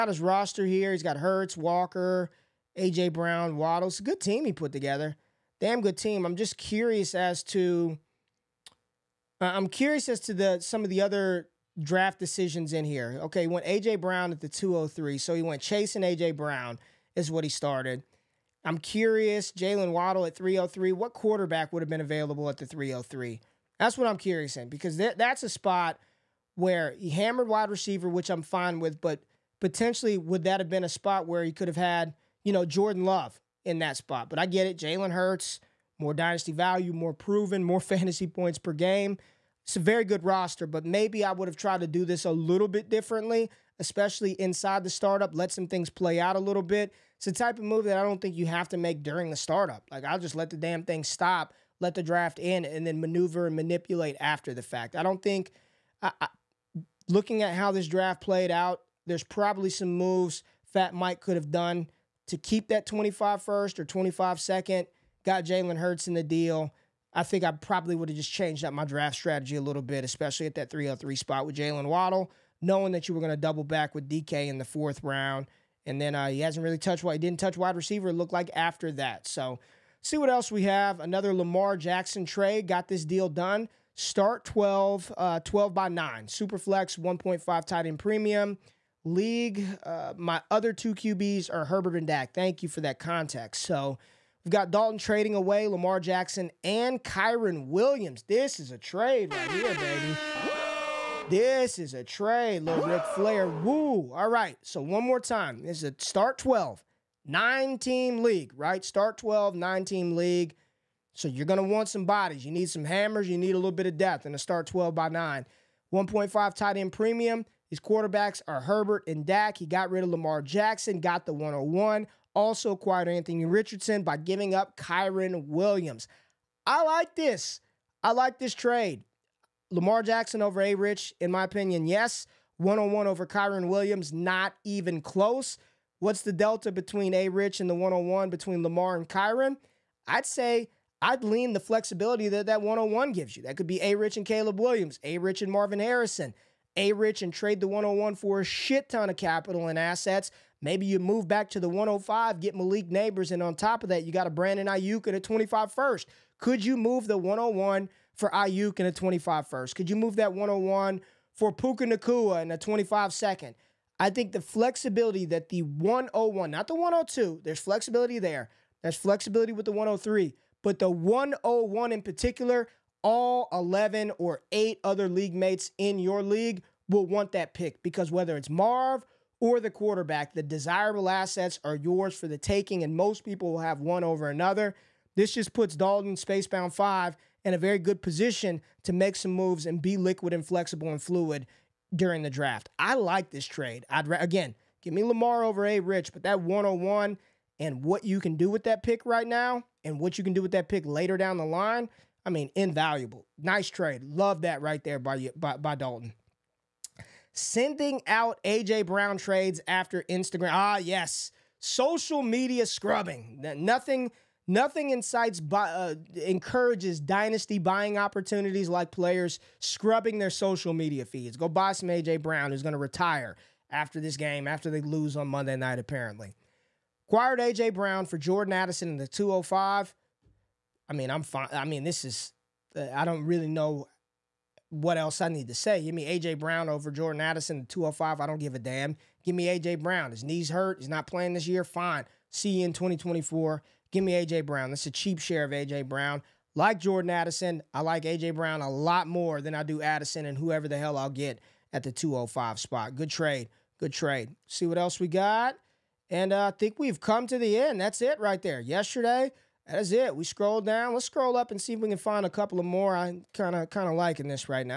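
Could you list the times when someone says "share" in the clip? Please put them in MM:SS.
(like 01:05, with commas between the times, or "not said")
04:05.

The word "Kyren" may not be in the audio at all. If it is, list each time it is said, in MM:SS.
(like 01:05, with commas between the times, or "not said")
01:37, 02:04, 02:13.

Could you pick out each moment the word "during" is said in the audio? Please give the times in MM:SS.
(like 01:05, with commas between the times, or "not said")
00:49, 03:11.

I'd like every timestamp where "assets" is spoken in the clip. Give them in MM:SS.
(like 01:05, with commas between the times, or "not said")
02:29, 03:01.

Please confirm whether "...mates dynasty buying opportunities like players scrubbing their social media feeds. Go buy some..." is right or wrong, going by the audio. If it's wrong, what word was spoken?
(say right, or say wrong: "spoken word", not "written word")
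wrong: "encourages", not "mates".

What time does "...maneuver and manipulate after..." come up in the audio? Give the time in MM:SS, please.
00:53.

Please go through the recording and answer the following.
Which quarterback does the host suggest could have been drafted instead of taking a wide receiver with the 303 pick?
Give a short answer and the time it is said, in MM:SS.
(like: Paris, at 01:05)
Jordan Love, at 00:32.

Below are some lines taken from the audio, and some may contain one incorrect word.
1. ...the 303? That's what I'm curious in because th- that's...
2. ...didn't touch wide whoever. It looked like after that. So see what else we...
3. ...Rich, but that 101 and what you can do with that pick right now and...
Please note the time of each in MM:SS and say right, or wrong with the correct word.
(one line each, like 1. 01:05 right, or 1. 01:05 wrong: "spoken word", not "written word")
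1. 00:22 right
2. 01:17 wrong: "receiver", not "whoever"
3. 03:15 right.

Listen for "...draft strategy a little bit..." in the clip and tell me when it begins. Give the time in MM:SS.
01:08.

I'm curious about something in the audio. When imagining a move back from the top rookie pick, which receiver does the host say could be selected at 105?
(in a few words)
Malik Nabers.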